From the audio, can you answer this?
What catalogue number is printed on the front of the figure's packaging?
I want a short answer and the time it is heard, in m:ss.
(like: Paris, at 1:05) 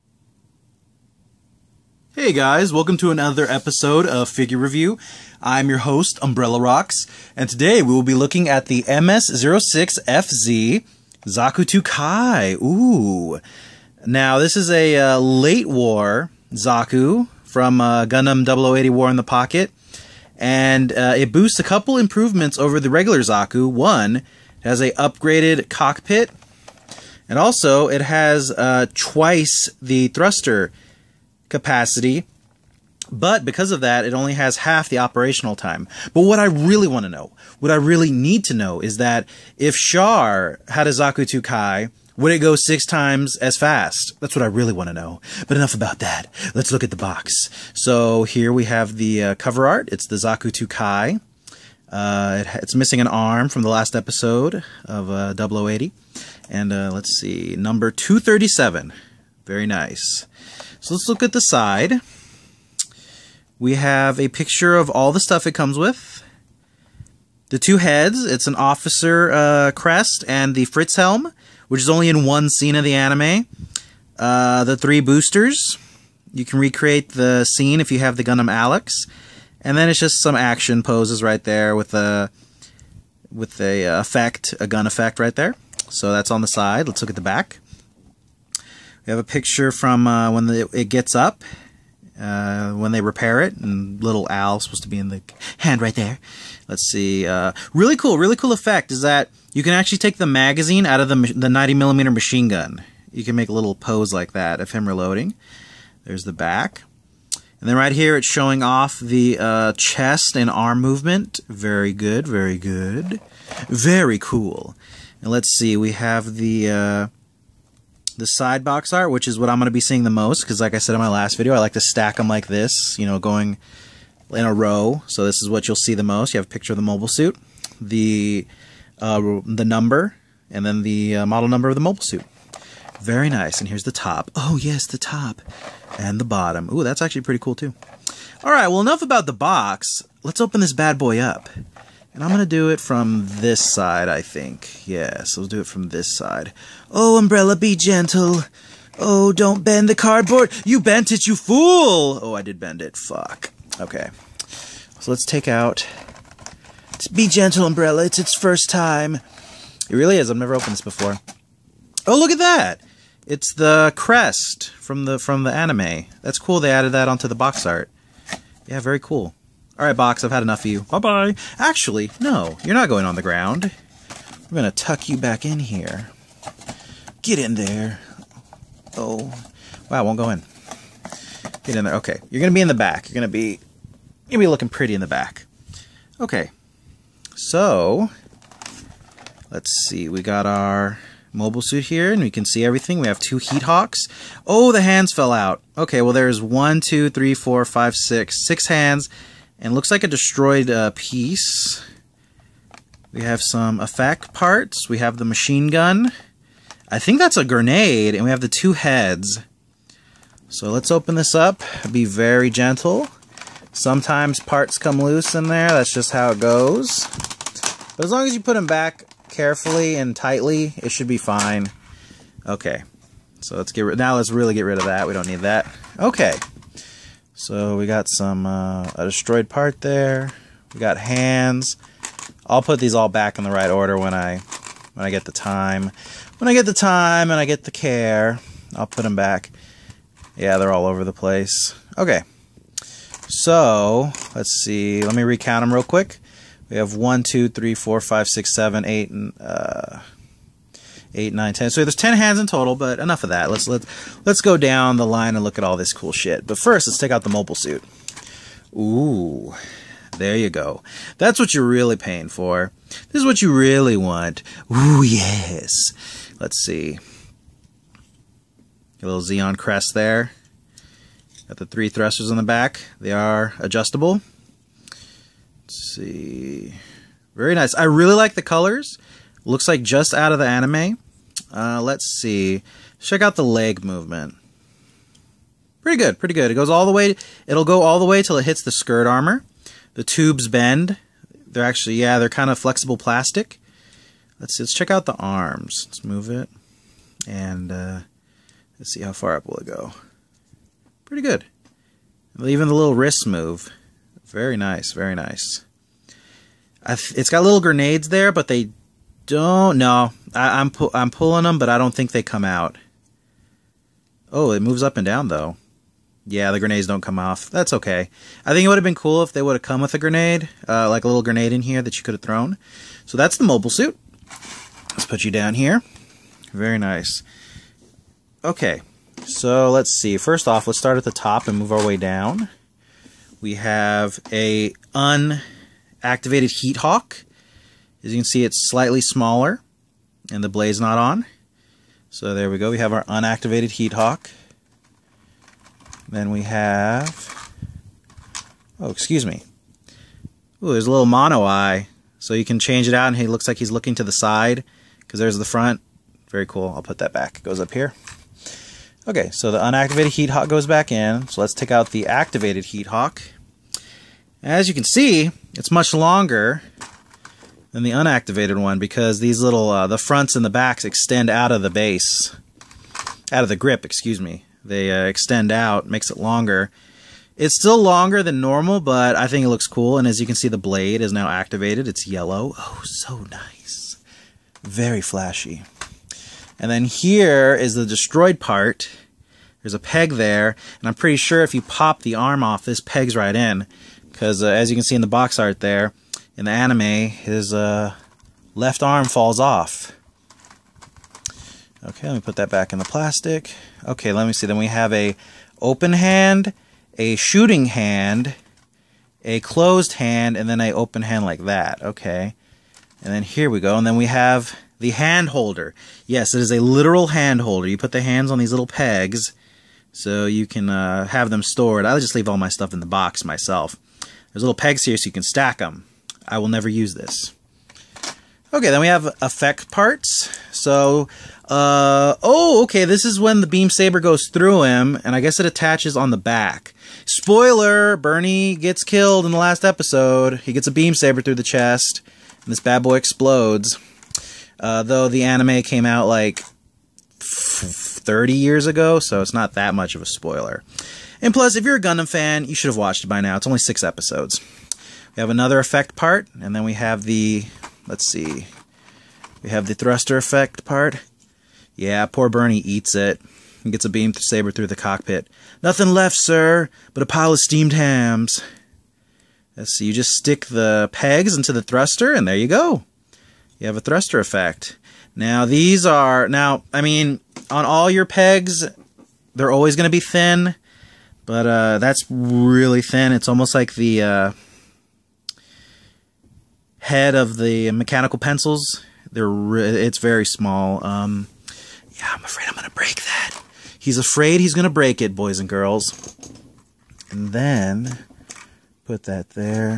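237, at 0:57.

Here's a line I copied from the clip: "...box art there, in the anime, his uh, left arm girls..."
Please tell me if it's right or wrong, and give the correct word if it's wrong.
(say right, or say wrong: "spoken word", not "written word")
wrong: "falls", not "girls".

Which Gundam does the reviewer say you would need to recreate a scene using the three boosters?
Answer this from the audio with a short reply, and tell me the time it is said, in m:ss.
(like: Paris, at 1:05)
Gundam Alex, at 1:18.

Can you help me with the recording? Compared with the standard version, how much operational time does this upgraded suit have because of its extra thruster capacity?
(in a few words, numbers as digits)
Half.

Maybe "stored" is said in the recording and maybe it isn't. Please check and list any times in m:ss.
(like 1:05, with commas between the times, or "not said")
7:01.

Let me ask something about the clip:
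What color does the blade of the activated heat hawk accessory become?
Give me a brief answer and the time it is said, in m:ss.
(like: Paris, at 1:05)
Yellow, at 6:21.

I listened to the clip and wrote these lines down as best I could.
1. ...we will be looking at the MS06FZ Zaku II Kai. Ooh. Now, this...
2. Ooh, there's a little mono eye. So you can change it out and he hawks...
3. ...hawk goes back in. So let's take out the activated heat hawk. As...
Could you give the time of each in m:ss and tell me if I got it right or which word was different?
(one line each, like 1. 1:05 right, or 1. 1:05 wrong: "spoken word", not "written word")
1. 0:07 right
2. 5:50 wrong: "looks", not "hawks"
3. 6:00 right.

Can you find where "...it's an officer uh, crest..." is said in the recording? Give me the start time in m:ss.
1:08.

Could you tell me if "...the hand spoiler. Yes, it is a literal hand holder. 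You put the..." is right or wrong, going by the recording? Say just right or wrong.
wrong.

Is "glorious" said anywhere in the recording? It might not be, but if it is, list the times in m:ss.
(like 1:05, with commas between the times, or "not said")
not said.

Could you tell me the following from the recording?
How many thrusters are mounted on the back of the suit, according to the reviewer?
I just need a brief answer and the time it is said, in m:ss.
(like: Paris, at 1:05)
3, at 4:31.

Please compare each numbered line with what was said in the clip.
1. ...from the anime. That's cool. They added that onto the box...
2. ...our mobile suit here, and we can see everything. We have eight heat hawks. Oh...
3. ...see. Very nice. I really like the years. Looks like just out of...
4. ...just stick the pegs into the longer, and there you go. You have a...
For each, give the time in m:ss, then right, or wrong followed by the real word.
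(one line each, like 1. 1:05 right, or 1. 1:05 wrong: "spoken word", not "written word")
1. 2:45 right
2. 3:10 wrong: "two", not "eight"
3. 4:35 wrong: "colors", not "years"
4. 7:49 wrong: "thruster", not "longer".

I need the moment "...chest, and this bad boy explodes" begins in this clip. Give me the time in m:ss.
7:21.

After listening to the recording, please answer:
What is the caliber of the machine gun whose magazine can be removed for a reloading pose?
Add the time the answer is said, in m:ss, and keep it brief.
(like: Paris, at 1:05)
90 millimeter, at 1:41.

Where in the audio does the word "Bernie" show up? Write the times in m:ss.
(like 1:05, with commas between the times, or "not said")
7:17, 7:42.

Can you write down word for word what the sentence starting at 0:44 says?
That's what I really want to know.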